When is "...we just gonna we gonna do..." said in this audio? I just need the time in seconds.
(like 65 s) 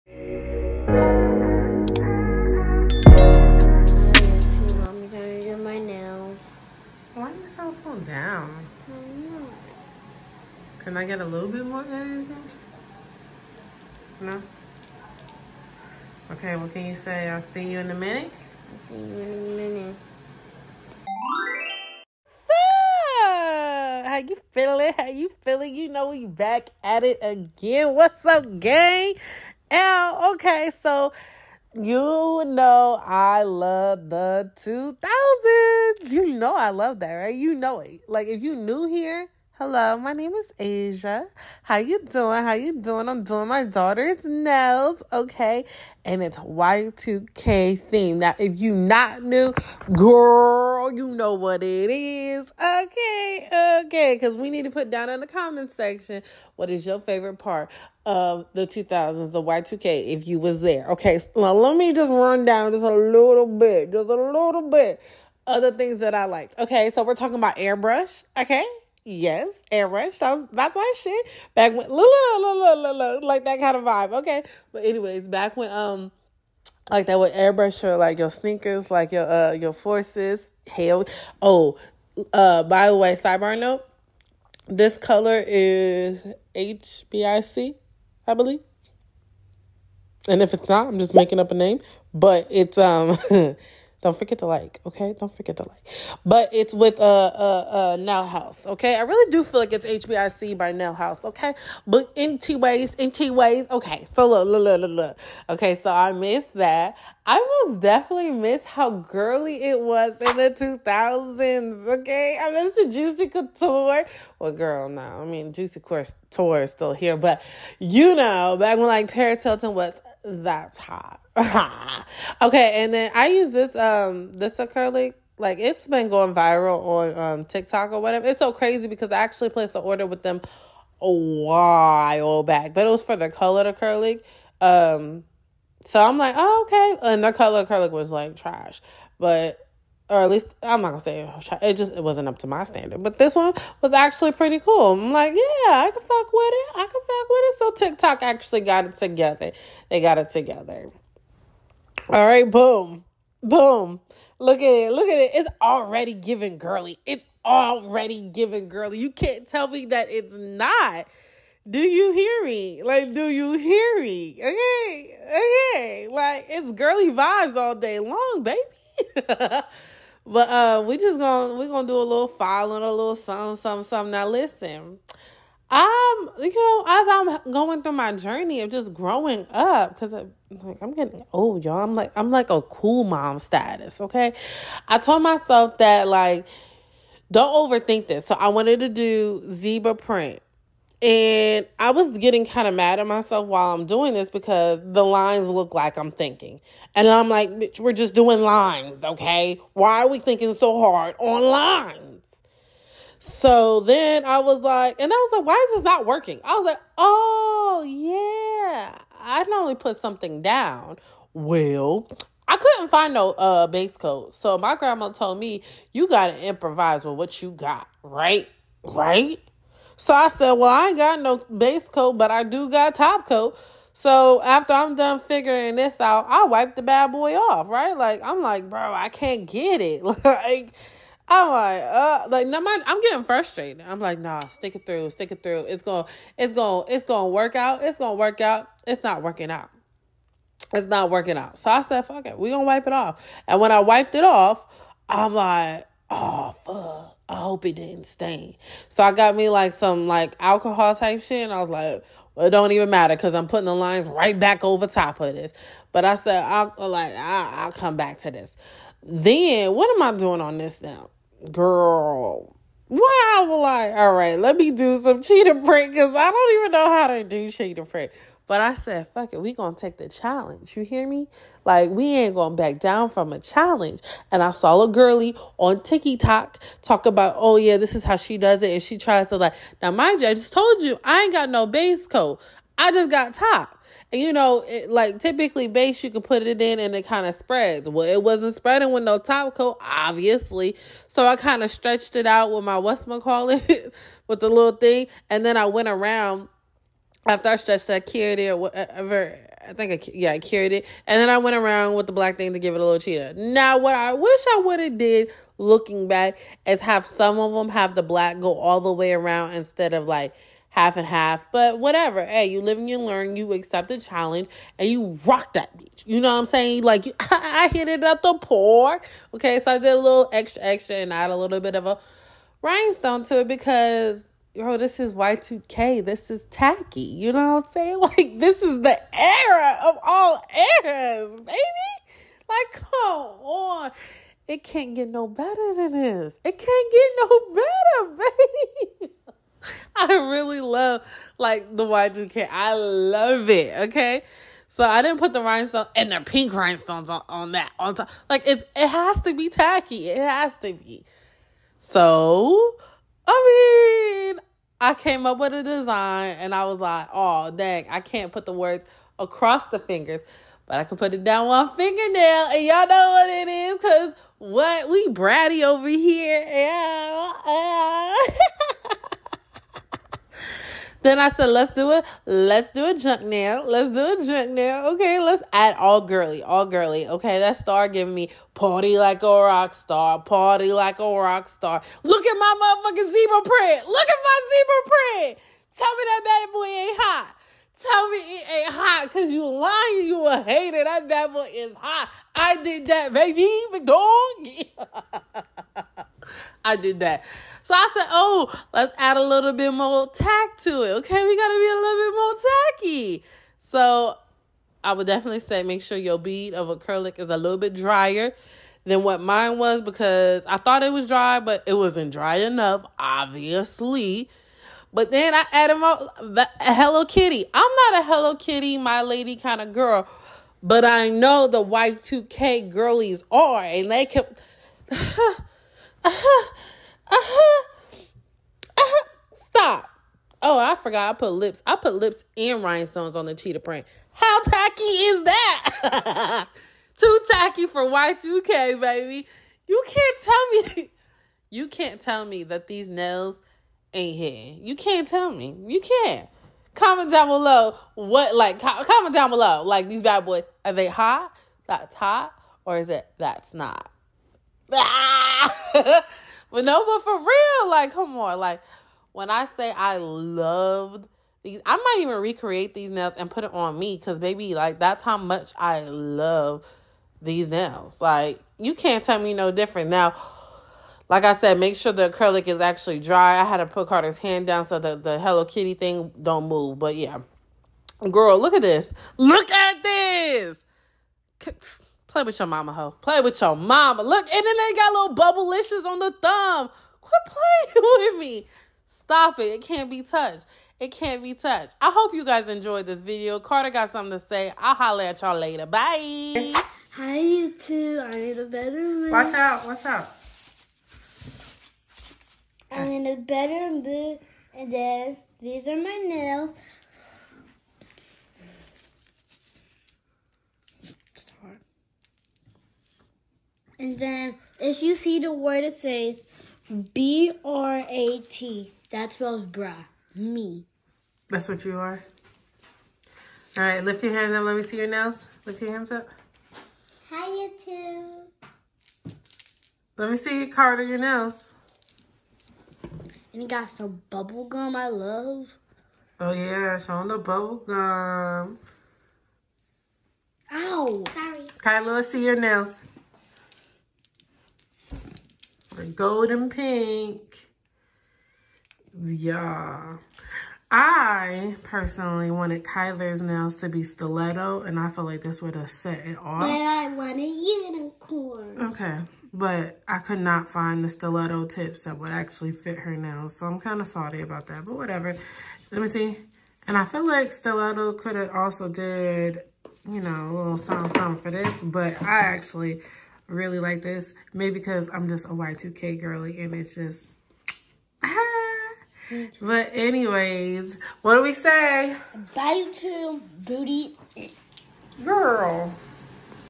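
170 s.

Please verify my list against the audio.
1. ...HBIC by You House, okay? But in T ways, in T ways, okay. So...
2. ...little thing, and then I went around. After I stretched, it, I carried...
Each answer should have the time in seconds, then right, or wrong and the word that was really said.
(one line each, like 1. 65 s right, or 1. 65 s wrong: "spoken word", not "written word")
1. 99 s wrong: "Now", not "You"
2. 294 s right.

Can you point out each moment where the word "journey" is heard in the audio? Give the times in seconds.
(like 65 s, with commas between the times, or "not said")
178 s.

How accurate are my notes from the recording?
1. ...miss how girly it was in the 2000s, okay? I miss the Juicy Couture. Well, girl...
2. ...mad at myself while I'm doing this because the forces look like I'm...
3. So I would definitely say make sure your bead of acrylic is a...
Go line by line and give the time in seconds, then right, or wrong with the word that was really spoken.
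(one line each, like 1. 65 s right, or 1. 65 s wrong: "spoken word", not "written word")
1. 108 s right
2. 192 s wrong: "lines", not "forces"
3. 403 s right.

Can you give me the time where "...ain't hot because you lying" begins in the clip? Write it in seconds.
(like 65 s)
388 s.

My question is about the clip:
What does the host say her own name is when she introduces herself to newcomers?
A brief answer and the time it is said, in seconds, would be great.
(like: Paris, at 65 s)
Asia, at 40 s.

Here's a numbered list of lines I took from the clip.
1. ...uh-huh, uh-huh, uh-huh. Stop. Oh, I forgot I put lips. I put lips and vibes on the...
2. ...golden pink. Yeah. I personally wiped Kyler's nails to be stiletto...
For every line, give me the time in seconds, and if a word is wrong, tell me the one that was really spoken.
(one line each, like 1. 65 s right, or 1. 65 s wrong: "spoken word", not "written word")
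1. 426 s wrong: "rhinestones", not "vibes"
2. 545 s wrong: "wanted", not "wiped".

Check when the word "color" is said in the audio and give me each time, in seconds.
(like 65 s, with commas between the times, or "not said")
84 s, 133 s, 137 s.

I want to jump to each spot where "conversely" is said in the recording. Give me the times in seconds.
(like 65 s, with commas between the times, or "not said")
not said.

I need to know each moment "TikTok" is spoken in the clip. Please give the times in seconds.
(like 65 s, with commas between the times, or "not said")
127 s, 147 s, 275 s.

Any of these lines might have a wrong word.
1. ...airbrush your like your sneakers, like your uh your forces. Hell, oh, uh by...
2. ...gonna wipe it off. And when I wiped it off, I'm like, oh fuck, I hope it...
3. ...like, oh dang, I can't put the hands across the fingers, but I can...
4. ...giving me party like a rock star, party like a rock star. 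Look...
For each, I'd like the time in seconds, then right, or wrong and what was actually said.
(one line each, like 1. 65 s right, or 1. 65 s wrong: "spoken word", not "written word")
1. 77 s right
2. 242 s right
3. 356 s wrong: "words", not "hands"
4. 377 s right.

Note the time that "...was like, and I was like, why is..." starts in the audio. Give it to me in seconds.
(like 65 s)
204 s.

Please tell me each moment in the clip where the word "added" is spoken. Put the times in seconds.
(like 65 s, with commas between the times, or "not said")
415 s.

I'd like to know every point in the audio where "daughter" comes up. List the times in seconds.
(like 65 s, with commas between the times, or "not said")
43 s.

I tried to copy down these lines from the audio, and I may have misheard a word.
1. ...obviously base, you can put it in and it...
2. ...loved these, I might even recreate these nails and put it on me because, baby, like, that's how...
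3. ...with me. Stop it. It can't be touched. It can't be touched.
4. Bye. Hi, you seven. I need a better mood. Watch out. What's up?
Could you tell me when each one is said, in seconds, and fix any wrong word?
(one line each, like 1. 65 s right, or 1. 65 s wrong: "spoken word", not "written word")
1. 285 s wrong: "typically", not "obviously"
2. 459 s right
3. 488 s right
4. 495 s wrong: "two", not "seven".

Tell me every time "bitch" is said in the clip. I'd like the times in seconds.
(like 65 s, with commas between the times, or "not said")
197 s, 315 s.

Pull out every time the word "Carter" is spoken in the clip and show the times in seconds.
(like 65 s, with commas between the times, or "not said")
473 s, 493 s.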